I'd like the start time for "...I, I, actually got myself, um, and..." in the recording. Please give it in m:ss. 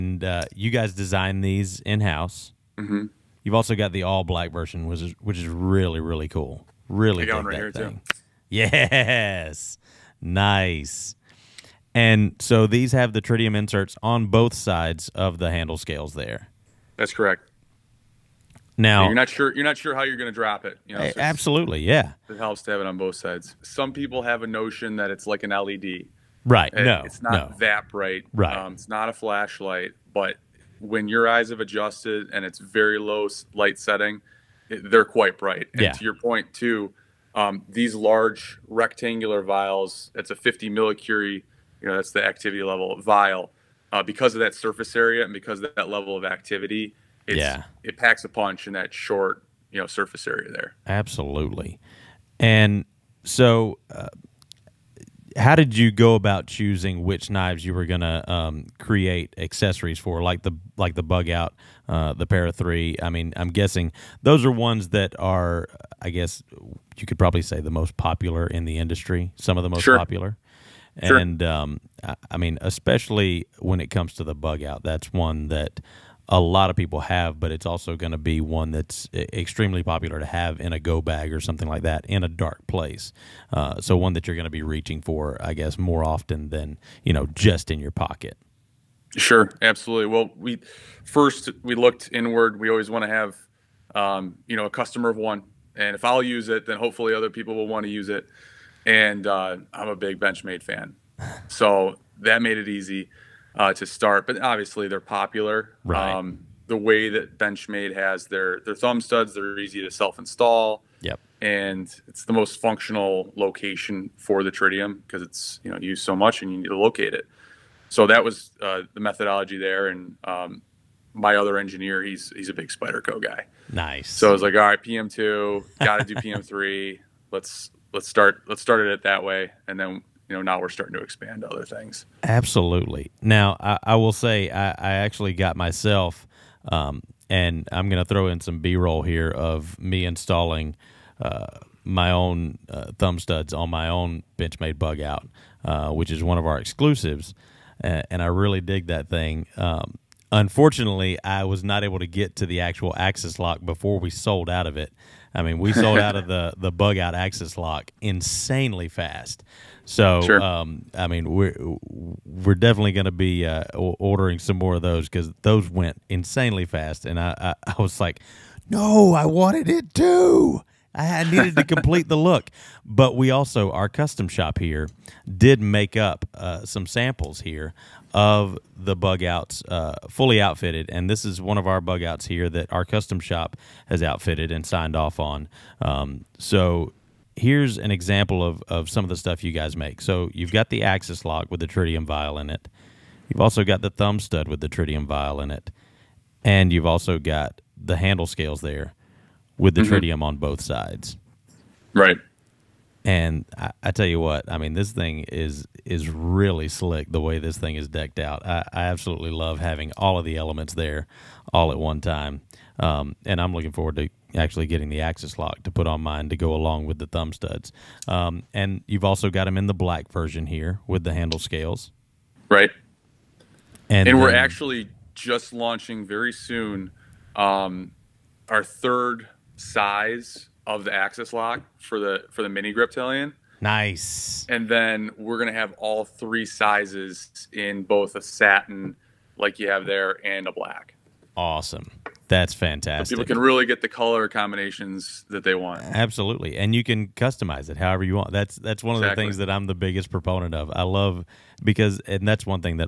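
2:14.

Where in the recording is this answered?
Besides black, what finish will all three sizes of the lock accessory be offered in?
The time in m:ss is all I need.
3:58.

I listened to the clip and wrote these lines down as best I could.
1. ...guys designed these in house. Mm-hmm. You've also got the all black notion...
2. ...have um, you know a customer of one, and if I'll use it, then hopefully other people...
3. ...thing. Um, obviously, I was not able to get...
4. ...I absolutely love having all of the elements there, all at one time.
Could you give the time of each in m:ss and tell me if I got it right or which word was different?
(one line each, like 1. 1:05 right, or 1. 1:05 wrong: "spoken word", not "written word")
1. 0:00 wrong: "version", not "notion"
2. 1:33 right
3. 2:29 wrong: "unfortunately", not "obviously"
4. 3:28 right.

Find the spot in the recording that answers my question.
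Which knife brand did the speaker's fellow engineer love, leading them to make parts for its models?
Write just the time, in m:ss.
2:02.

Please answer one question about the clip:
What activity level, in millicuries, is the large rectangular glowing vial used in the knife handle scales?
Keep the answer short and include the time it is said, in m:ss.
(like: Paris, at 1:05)
50 millicurie, at 0:40.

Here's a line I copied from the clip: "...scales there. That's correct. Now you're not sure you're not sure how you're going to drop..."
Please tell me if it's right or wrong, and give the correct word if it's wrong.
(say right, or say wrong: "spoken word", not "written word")
right.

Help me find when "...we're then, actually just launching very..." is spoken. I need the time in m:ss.
3:44.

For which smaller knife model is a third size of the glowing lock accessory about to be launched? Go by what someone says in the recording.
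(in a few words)
mini Griptilian.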